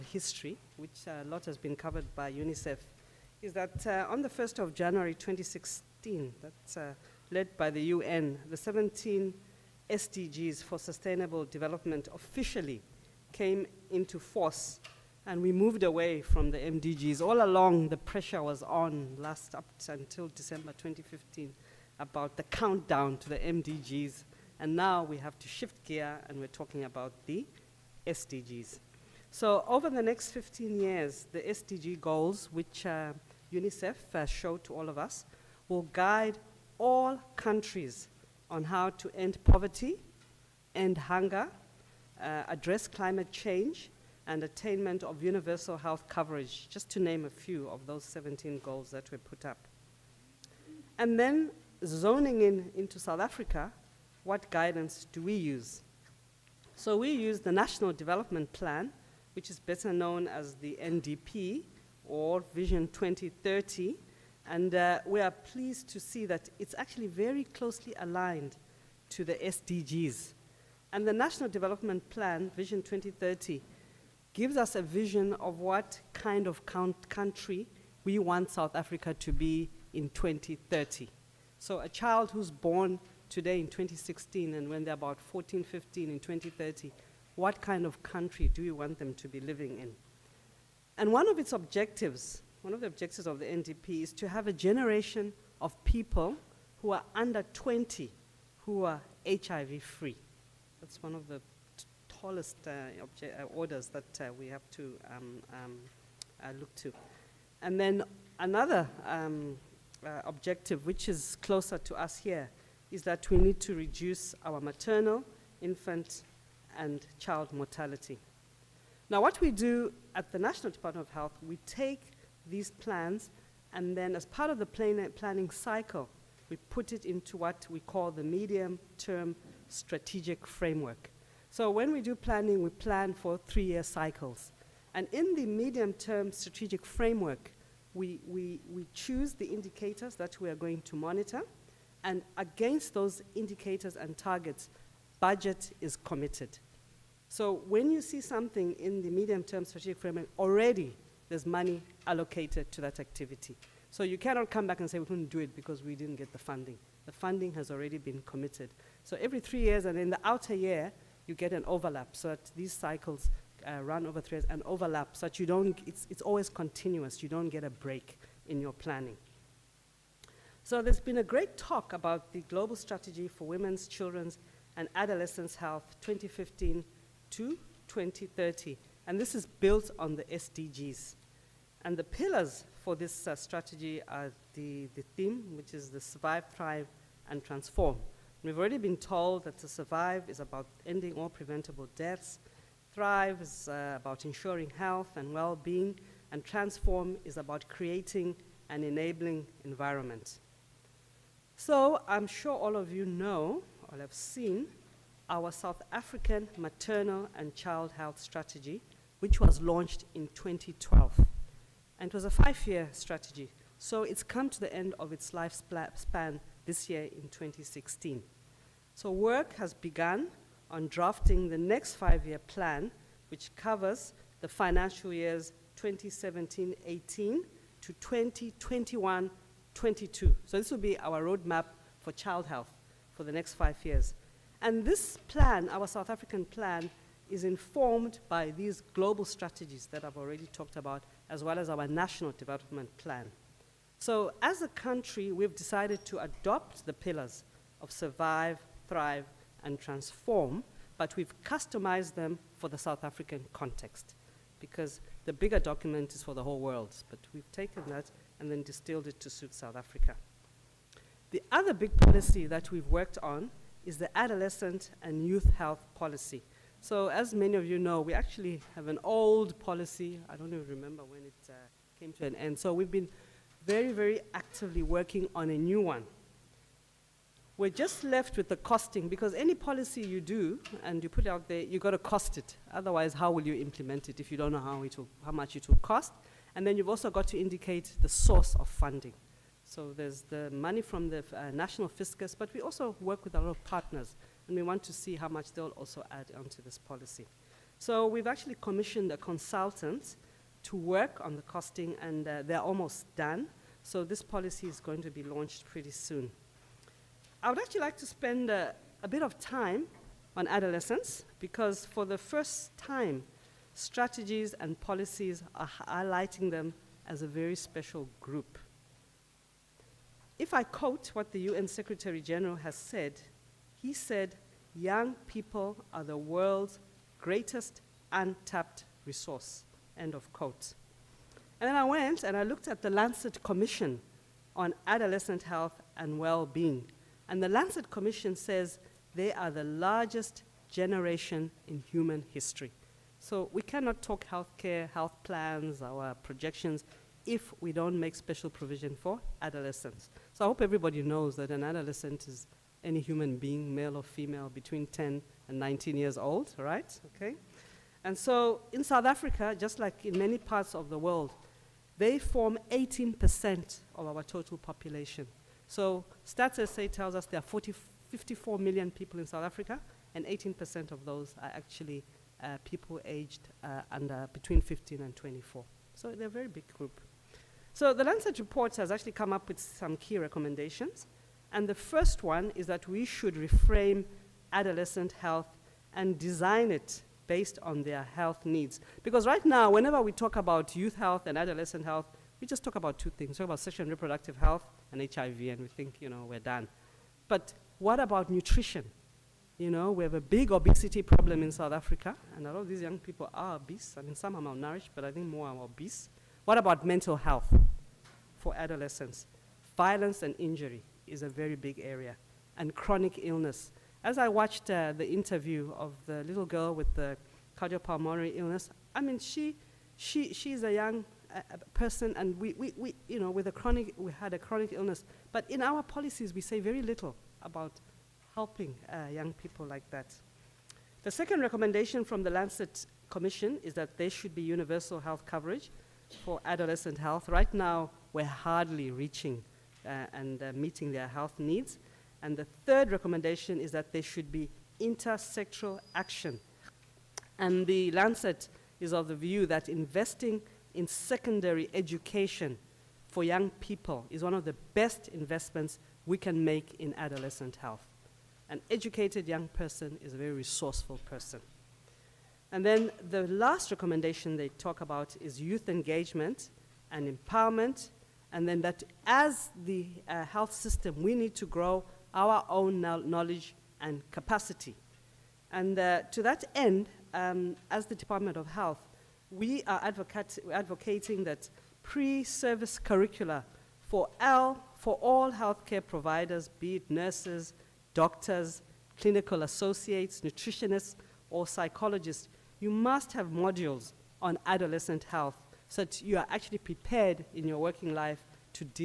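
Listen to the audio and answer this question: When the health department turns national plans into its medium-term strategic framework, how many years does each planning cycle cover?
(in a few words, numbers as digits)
3 years.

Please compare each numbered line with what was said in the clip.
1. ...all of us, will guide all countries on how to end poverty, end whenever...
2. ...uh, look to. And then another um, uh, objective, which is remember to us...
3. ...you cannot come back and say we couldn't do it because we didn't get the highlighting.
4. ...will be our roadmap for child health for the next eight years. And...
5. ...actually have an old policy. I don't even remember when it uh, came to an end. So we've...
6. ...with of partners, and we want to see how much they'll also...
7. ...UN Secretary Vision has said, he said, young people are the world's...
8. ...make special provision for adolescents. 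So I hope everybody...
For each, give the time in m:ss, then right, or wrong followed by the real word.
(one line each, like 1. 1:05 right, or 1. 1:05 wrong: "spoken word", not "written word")
1. 0:34 wrong: "hunger", not "whenever"
2. 1:46 wrong: "closer", not "remember"
3. 2:34 wrong: "funding", not "highlighting"
4. 3:50 wrong: "five", not "eight"
5. 4:28 right
6. 4:53 right
7. 5:21 wrong: "General", not "Vision"
8. 5:47 right.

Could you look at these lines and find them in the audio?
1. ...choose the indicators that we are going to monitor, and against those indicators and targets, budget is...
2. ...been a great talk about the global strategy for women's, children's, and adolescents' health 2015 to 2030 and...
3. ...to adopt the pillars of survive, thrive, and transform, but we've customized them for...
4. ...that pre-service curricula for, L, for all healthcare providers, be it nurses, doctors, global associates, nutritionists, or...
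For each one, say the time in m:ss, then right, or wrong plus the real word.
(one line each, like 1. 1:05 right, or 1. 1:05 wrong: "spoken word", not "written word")
1. 2:18 right
2. 2:50 right
3. 4:06 right
4. 8:01 wrong: "clinical", not "global".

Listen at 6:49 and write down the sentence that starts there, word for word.
Violence and injury is a very big area, and chronic illness.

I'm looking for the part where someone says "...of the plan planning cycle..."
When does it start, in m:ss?
2:04.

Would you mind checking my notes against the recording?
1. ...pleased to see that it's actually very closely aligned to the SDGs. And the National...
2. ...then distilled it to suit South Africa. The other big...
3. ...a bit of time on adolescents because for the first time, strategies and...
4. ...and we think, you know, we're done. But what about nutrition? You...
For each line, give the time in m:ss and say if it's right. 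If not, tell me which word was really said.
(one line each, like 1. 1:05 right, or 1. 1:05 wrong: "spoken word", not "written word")
1. 1:05 right
2. 4:18 right
3. 5:09 right
4. 6:35 right.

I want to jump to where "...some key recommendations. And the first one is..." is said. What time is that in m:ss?
6:19.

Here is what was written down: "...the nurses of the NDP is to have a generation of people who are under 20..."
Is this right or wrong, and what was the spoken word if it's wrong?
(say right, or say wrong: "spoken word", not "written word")
wrong: "objectives", not "nurses".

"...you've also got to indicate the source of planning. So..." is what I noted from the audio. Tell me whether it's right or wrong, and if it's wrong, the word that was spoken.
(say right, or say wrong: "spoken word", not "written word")
wrong: "funding", not "planning".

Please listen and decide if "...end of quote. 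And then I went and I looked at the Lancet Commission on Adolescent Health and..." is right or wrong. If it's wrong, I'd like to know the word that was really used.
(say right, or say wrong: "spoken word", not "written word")
right.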